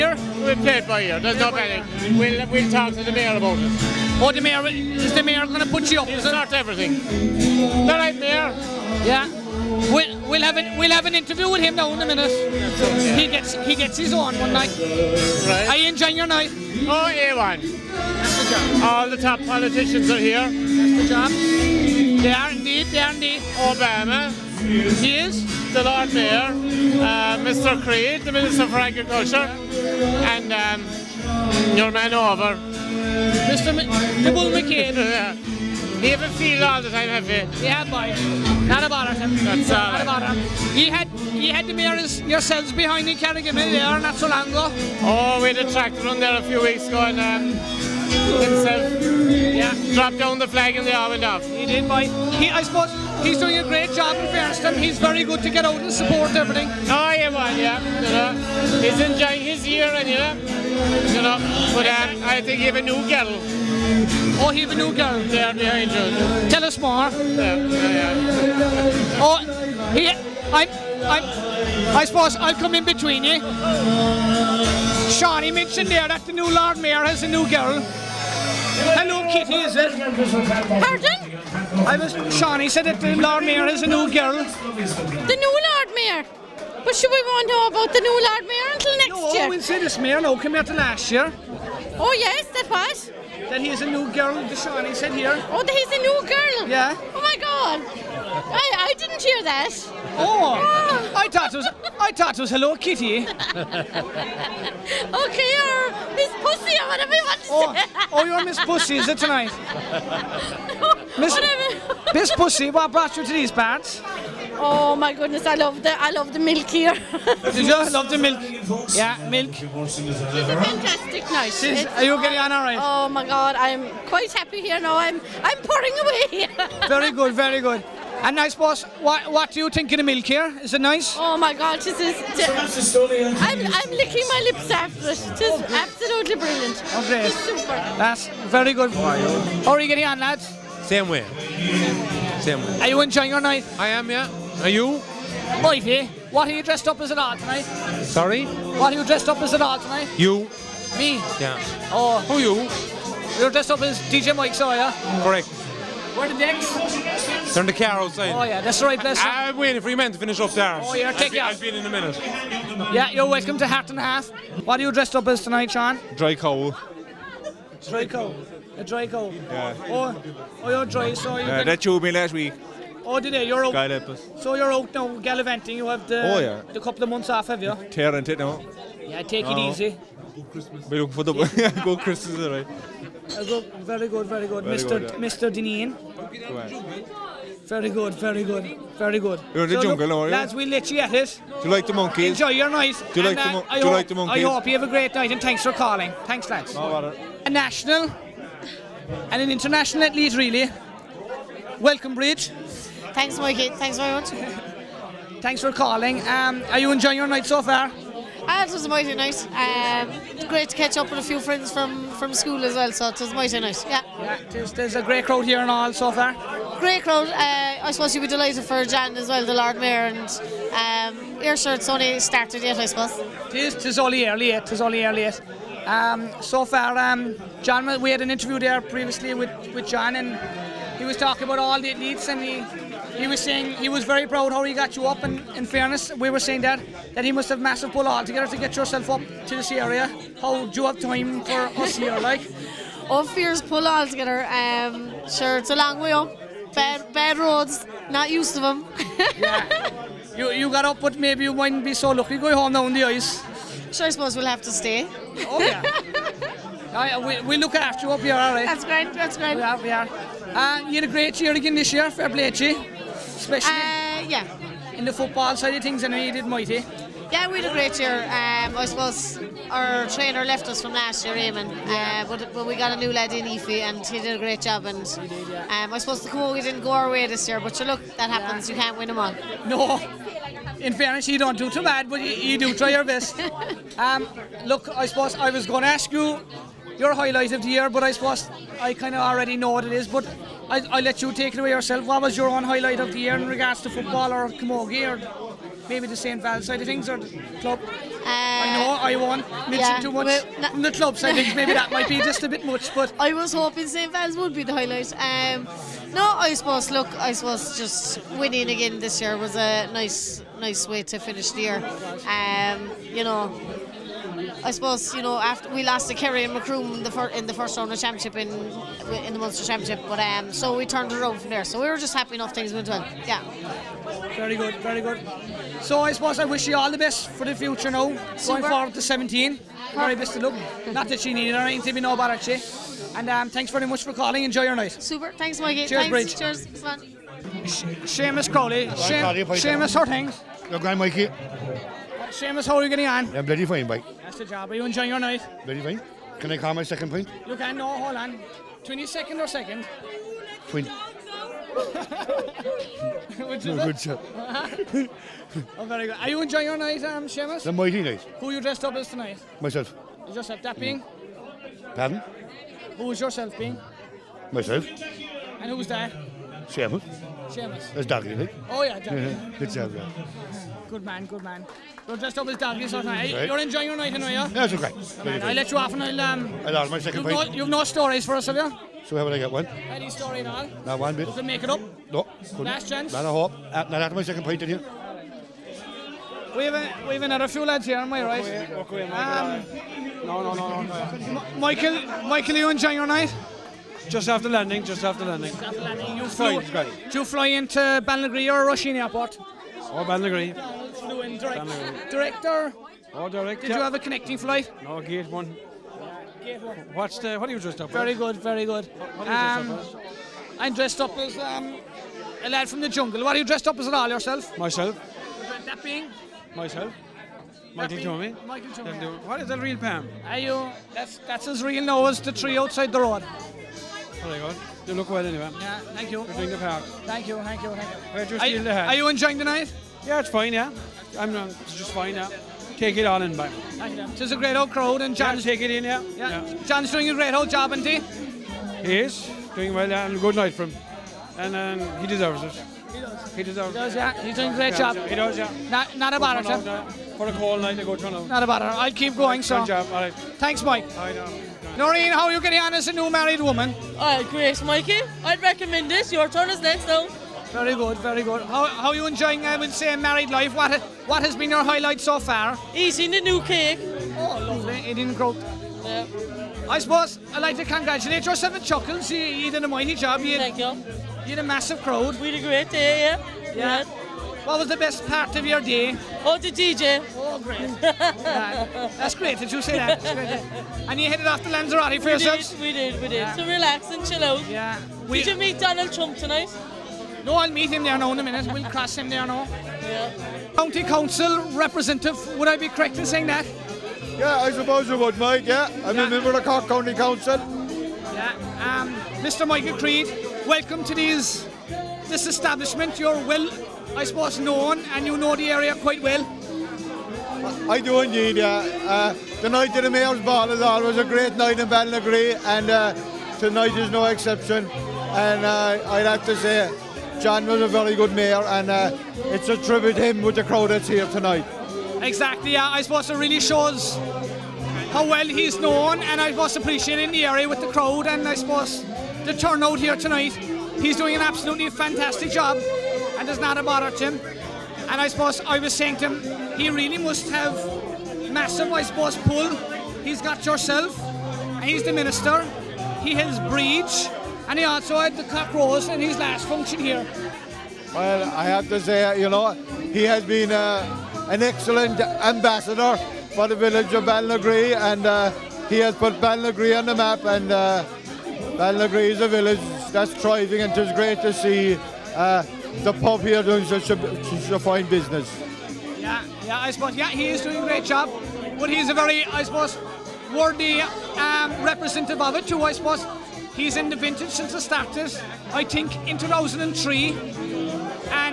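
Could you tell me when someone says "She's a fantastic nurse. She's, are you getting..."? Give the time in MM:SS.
01:59.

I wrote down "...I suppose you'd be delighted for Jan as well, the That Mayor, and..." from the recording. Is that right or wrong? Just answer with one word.
wrong.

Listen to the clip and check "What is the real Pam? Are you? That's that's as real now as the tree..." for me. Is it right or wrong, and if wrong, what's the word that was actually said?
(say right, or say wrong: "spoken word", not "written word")
right.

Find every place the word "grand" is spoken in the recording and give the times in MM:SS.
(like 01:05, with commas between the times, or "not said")
05:40.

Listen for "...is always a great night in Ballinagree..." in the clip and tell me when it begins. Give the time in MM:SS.
08:30.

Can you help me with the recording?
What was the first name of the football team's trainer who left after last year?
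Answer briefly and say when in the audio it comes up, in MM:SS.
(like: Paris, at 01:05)
Eamon, at 04:31.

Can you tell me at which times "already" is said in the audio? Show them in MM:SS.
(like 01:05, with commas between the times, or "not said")
04:49.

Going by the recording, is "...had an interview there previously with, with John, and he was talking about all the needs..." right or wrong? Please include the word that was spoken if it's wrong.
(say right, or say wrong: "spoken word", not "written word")
right.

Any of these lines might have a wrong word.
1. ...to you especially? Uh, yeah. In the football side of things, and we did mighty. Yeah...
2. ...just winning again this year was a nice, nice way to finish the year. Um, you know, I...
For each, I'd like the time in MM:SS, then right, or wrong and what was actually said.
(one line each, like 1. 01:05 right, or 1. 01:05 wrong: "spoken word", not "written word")
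1. 04:22 right
2. 05:07 right.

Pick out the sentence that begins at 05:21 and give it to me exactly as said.
So we were just happy enough things went well.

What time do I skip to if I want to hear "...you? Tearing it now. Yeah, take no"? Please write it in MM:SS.
02:57.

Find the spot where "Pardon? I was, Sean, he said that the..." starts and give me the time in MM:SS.
01:20.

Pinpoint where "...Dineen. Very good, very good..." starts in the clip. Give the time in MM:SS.
03:05.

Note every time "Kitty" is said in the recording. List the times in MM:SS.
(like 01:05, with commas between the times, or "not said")
01:19, 01:42.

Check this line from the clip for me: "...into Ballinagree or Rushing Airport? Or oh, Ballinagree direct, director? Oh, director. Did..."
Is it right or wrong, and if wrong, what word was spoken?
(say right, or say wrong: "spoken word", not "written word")
right.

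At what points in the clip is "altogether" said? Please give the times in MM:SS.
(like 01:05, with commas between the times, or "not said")
03:58, 04:03.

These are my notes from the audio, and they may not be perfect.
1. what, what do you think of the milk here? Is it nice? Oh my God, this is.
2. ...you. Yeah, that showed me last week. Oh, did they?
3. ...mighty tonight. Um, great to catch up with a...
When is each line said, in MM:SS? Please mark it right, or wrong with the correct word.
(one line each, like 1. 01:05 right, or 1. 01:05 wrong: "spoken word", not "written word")
1. 02:09 right
2. 02:51 right
3. 03:28 wrong: "night", not "tonight".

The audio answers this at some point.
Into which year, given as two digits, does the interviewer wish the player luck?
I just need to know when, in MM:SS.
05:29.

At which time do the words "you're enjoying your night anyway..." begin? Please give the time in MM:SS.
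06:13.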